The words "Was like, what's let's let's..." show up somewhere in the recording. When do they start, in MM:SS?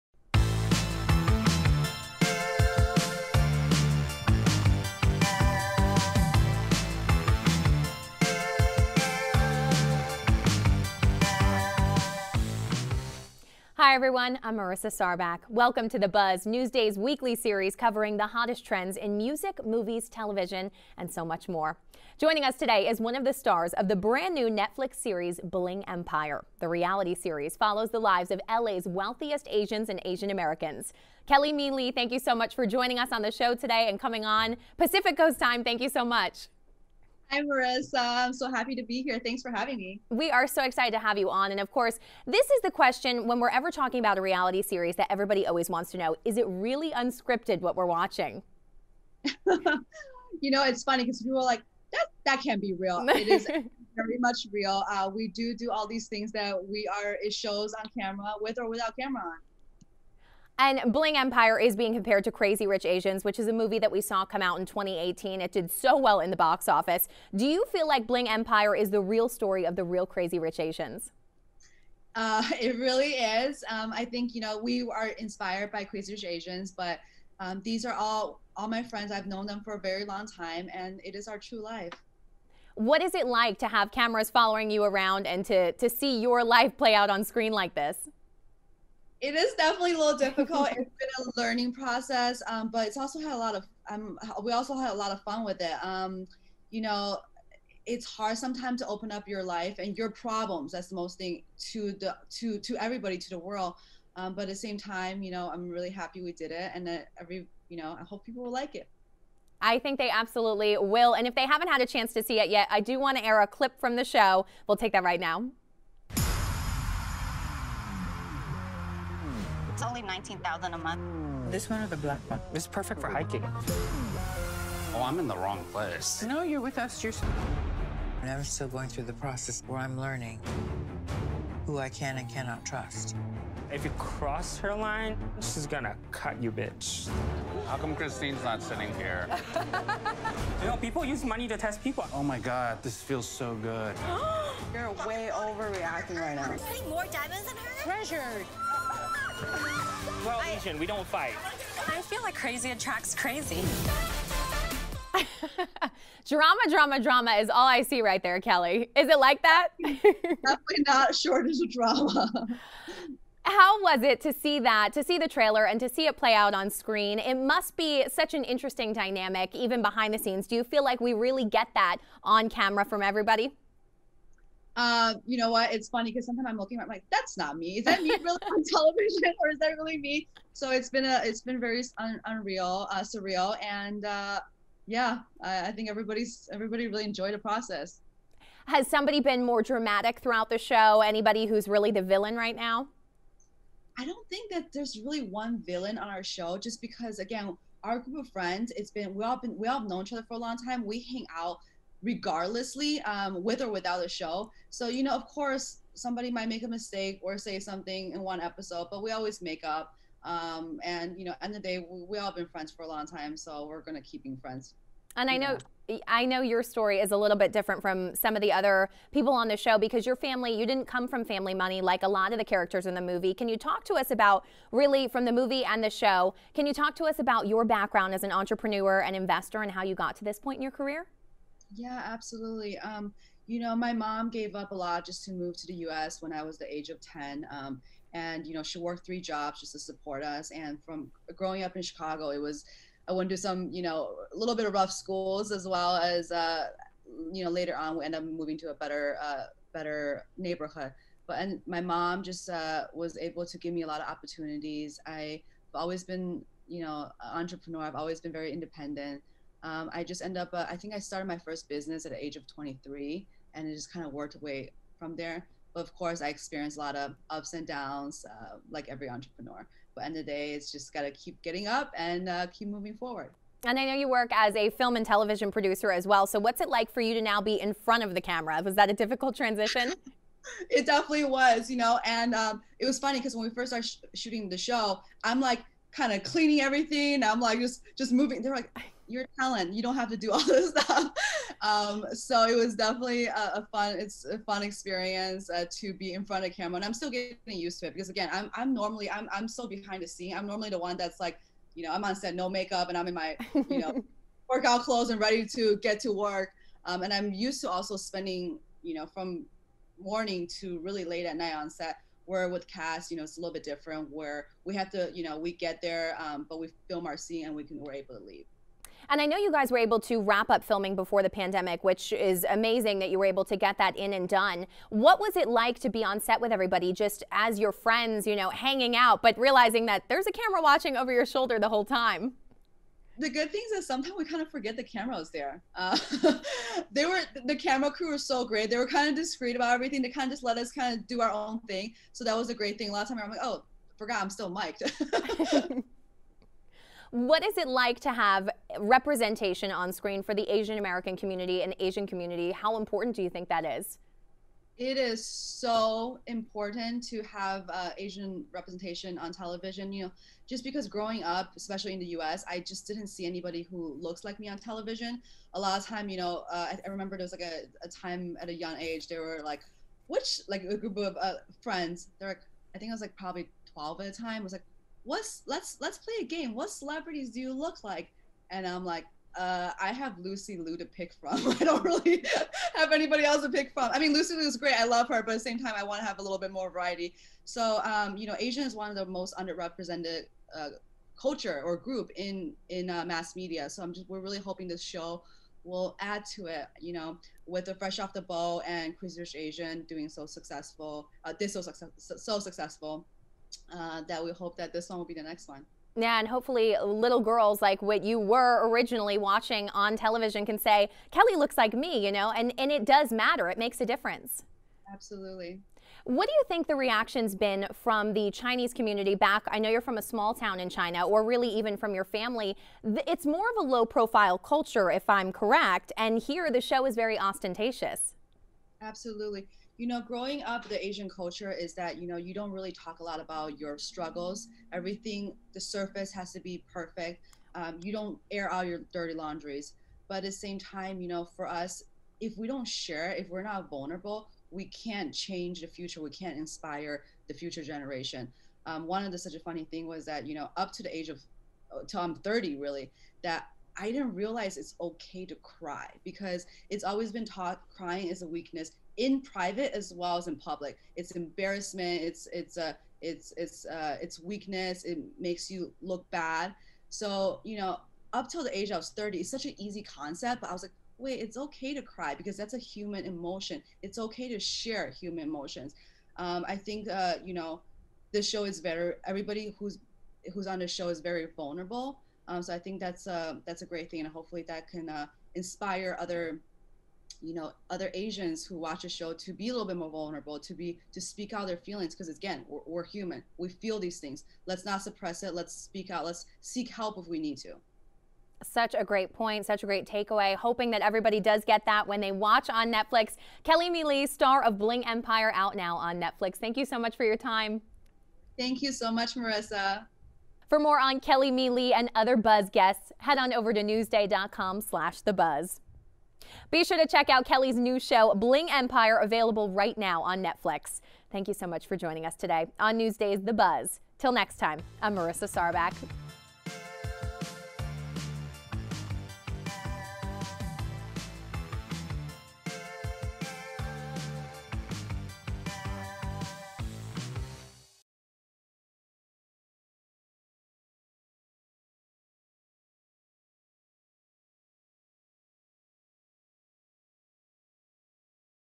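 06:14.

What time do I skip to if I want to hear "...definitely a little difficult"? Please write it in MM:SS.
01:29.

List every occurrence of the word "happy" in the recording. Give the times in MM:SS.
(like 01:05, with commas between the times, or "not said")
00:38, 01:45.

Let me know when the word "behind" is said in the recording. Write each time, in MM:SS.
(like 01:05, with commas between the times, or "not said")
02:49, 04:59.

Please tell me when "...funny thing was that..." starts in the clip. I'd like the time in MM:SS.
07:29.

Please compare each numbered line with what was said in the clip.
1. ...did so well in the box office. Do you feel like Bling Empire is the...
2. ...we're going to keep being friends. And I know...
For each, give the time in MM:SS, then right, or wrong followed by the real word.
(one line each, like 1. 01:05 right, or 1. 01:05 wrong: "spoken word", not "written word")
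1. 01:05 right
2. 03:33 right.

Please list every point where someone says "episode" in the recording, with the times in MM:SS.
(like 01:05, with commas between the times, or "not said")
03:28.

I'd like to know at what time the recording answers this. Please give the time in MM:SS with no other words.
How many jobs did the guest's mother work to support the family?
03:59.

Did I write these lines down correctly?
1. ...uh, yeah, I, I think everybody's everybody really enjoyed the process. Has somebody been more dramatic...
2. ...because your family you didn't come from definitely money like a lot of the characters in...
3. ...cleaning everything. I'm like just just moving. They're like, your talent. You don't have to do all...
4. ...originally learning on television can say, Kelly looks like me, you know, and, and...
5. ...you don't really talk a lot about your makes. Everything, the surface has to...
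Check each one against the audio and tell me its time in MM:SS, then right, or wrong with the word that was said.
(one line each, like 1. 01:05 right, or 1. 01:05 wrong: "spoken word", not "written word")
1. 03:04 right
2. 03:39 wrong: "family", not "definitely"
3. 04:46 right
4. 06:48 wrong: "watching", not "learning"
5. 07:12 wrong: "struggles", not "makes".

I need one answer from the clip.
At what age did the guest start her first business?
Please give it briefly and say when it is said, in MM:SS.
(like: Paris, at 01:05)
23, at 04:22.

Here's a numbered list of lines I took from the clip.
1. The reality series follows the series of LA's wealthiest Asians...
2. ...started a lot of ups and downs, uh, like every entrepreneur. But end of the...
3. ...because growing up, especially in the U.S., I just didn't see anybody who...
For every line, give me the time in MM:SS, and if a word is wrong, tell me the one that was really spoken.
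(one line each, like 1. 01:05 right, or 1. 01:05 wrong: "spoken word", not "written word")
1. 00:26 wrong: "lives", not "series"
2. 04:26 wrong: "experienced", not "started"
3. 06:00 right.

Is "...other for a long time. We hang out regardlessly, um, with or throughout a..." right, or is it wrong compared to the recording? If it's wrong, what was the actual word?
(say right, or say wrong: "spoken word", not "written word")
wrong: "without", not "throughout".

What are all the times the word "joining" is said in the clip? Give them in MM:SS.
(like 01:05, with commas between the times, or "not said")
00:22, 00:32, 08:41.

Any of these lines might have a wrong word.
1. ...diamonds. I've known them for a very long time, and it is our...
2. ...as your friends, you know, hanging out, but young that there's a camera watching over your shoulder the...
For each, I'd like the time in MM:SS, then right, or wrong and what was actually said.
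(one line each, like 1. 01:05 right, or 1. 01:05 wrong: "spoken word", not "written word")
1. 01:18 wrong: "friends", not "diamonds"
2. 05:27 wrong: "realizing", not "young".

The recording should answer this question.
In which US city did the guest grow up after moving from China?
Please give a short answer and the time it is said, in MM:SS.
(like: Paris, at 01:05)
Chicago, at 04:01.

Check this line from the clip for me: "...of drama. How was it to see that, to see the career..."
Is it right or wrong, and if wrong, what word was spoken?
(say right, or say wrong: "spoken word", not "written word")
wrong: "trailer", not "career".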